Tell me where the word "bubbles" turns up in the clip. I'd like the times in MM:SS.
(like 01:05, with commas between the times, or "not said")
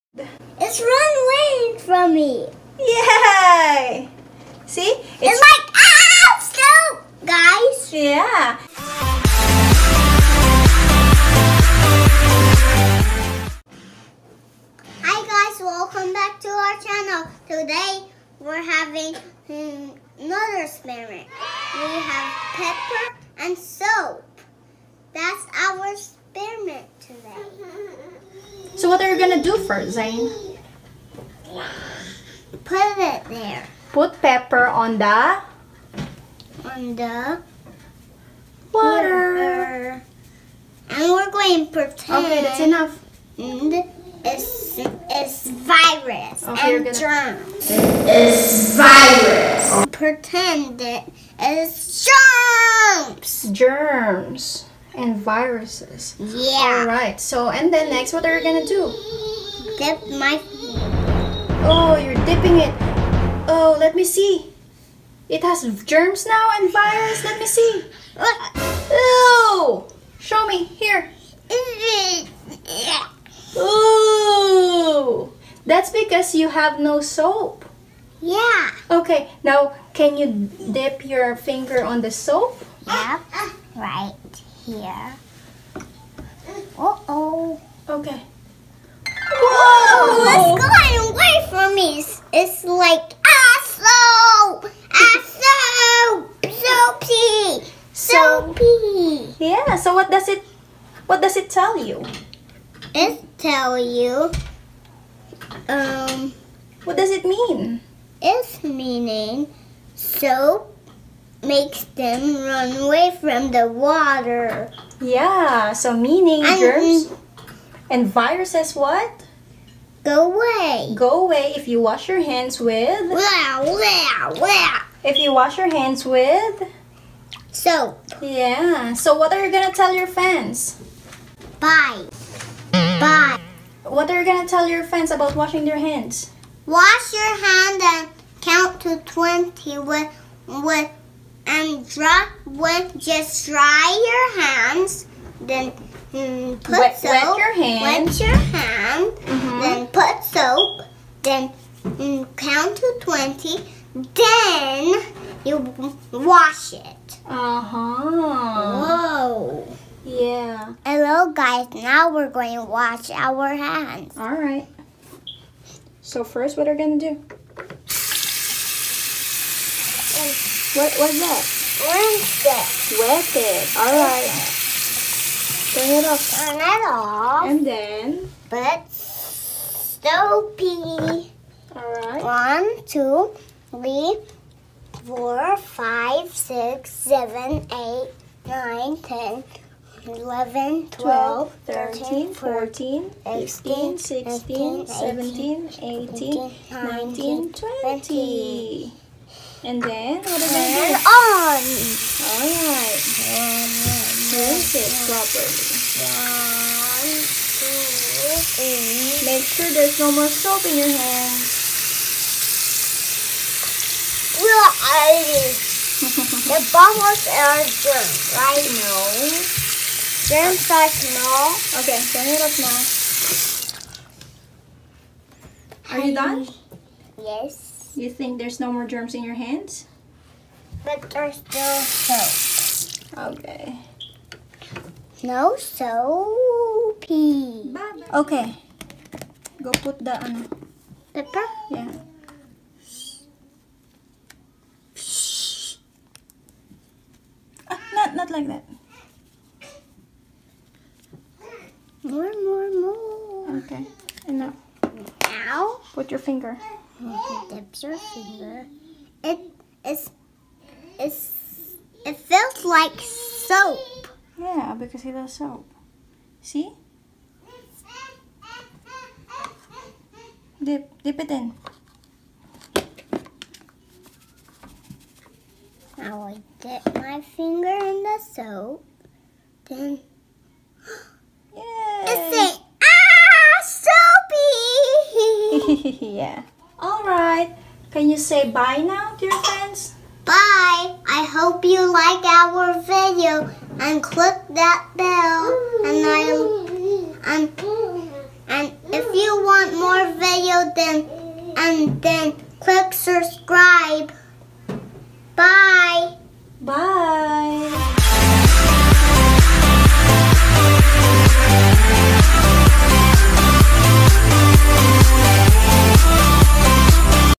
03:36.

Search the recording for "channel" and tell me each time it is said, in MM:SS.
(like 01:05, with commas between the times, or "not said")
00:16.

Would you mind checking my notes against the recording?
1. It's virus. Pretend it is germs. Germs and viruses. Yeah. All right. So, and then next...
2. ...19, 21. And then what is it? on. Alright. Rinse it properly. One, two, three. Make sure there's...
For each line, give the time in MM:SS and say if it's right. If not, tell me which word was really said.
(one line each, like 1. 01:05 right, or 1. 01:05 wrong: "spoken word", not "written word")
1. 00:47 right
2. 03:16 wrong: "20", not "21".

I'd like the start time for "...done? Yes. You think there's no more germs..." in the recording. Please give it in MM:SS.
03:46.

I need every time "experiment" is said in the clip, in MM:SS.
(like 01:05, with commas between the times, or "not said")
00:20, 00:25.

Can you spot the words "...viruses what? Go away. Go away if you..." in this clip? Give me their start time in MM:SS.
01:58.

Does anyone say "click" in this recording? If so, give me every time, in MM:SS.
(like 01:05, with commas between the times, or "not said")
04:54, 05:02.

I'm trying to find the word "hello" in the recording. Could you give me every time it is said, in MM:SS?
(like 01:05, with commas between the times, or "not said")
02:40.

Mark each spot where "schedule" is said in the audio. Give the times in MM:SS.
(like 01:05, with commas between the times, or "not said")
not said.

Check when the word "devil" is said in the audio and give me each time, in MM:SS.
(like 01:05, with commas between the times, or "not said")
not said.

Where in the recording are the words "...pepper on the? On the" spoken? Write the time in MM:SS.
00:34.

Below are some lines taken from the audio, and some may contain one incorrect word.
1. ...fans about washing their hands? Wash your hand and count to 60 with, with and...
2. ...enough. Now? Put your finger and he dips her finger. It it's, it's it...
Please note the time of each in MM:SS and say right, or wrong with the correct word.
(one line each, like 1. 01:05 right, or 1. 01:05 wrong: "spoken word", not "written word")
1. 02:14 wrong: "20", not "60"
2. 04:14 right.